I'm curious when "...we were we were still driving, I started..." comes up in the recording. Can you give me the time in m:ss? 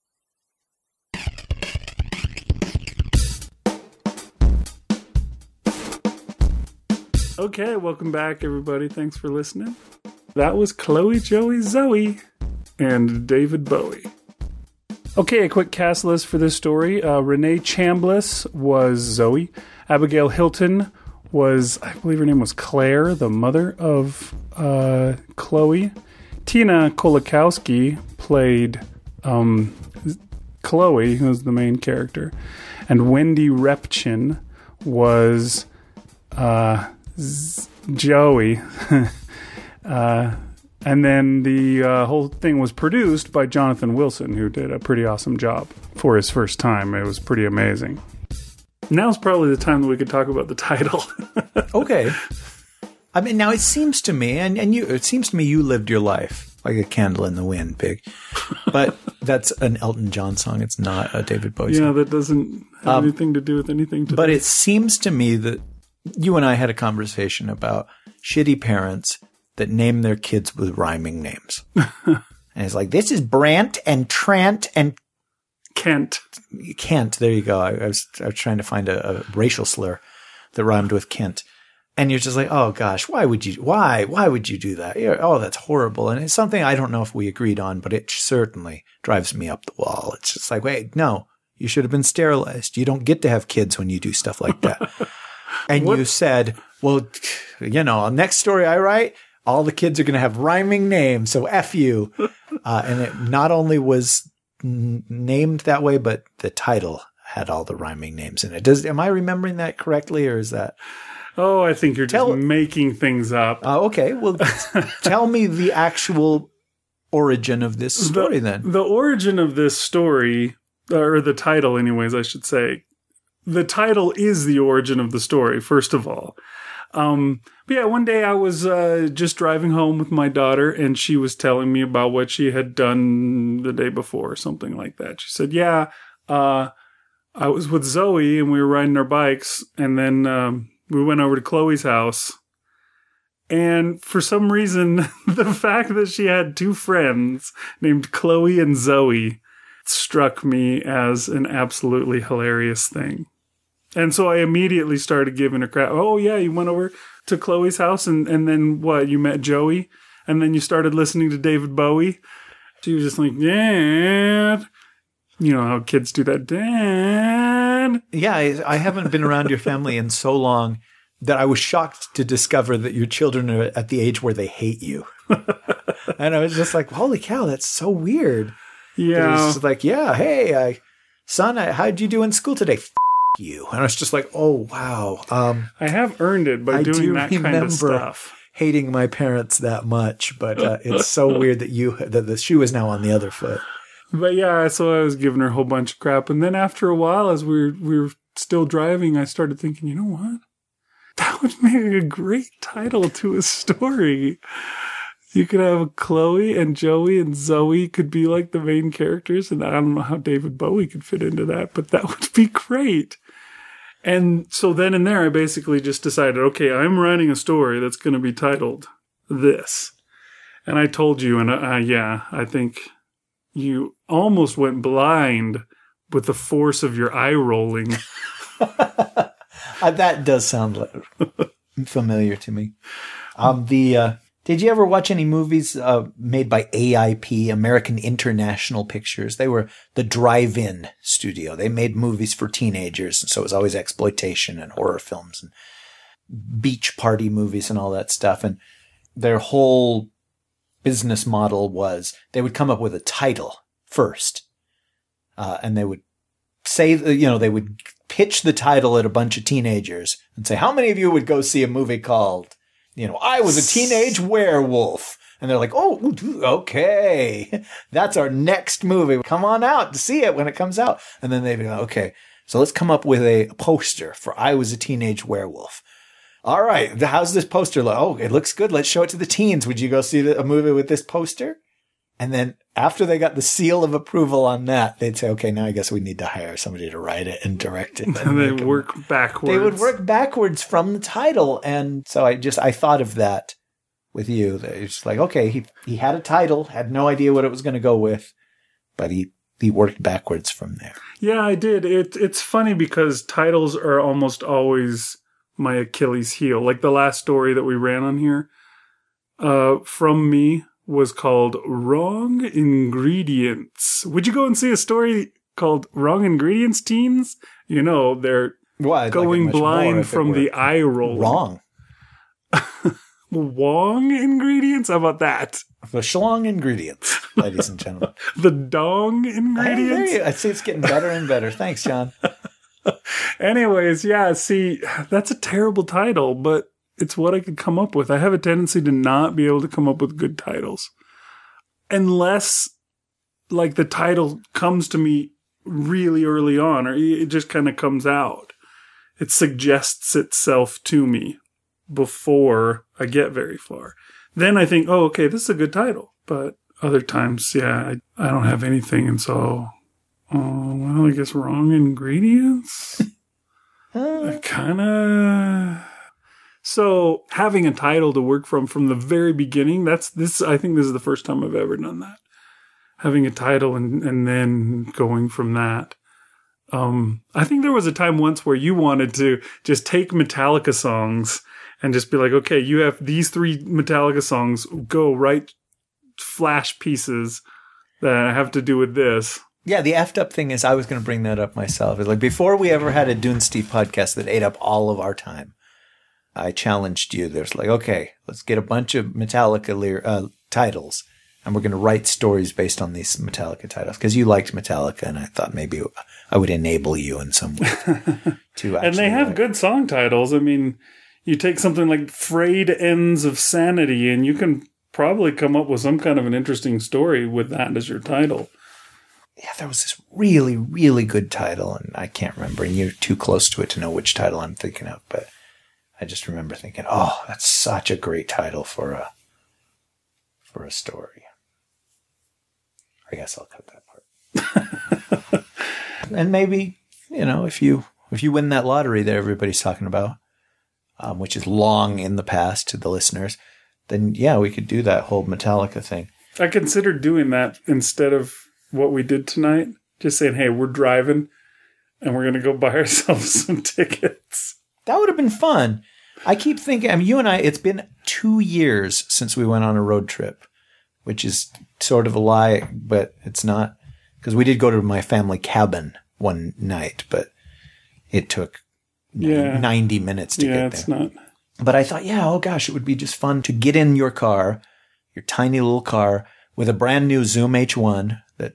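3:17.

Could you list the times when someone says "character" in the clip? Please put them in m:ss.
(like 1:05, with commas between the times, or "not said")
0:31, 3:28.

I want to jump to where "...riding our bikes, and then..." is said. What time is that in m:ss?
2:18.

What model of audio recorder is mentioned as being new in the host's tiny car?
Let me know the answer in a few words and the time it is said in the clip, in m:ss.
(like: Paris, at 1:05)
Zoom H1, at 7:57.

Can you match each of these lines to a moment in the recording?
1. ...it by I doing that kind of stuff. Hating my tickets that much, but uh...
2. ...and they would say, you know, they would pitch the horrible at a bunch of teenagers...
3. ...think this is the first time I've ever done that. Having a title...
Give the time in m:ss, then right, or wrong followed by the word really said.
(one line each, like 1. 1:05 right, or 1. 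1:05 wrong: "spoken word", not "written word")
1. 3:06 wrong: "parents", not "tickets"
2. 4:15 wrong: "title", not "horrible"
3. 6:10 right.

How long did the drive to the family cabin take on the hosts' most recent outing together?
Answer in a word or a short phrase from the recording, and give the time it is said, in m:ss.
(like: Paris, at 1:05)
90 minutes, at 7:49.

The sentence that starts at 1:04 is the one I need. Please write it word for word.
But it seems to me that you and I had a conversation about shitty parents that name their kids with rhyming names.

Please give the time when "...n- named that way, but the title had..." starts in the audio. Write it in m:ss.
1:44.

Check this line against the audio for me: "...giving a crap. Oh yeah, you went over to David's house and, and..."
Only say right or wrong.
wrong.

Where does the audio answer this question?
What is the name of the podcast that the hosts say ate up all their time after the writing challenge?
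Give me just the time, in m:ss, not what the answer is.
6:33.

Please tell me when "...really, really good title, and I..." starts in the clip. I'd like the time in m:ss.
7:00.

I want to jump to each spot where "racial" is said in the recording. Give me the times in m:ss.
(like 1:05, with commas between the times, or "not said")
1:19.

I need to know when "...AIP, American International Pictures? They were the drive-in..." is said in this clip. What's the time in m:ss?
3:56.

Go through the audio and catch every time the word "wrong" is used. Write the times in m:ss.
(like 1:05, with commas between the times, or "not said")
5:11, 5:15, 5:21, 6:01.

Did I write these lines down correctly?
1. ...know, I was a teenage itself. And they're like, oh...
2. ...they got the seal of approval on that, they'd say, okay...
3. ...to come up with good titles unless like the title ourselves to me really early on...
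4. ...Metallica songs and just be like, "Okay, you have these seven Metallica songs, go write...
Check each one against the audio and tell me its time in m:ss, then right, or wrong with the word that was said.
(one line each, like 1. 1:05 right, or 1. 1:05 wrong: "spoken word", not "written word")
1. 4:23 wrong: "werewolf", not "itself"
2. 4:43 right
3. 5:39 wrong: "comes", not "ourselves"
4. 6:20 wrong: "three", not "seven".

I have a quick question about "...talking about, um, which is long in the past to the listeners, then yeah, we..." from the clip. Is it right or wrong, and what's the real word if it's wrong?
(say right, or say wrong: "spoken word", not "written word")
right.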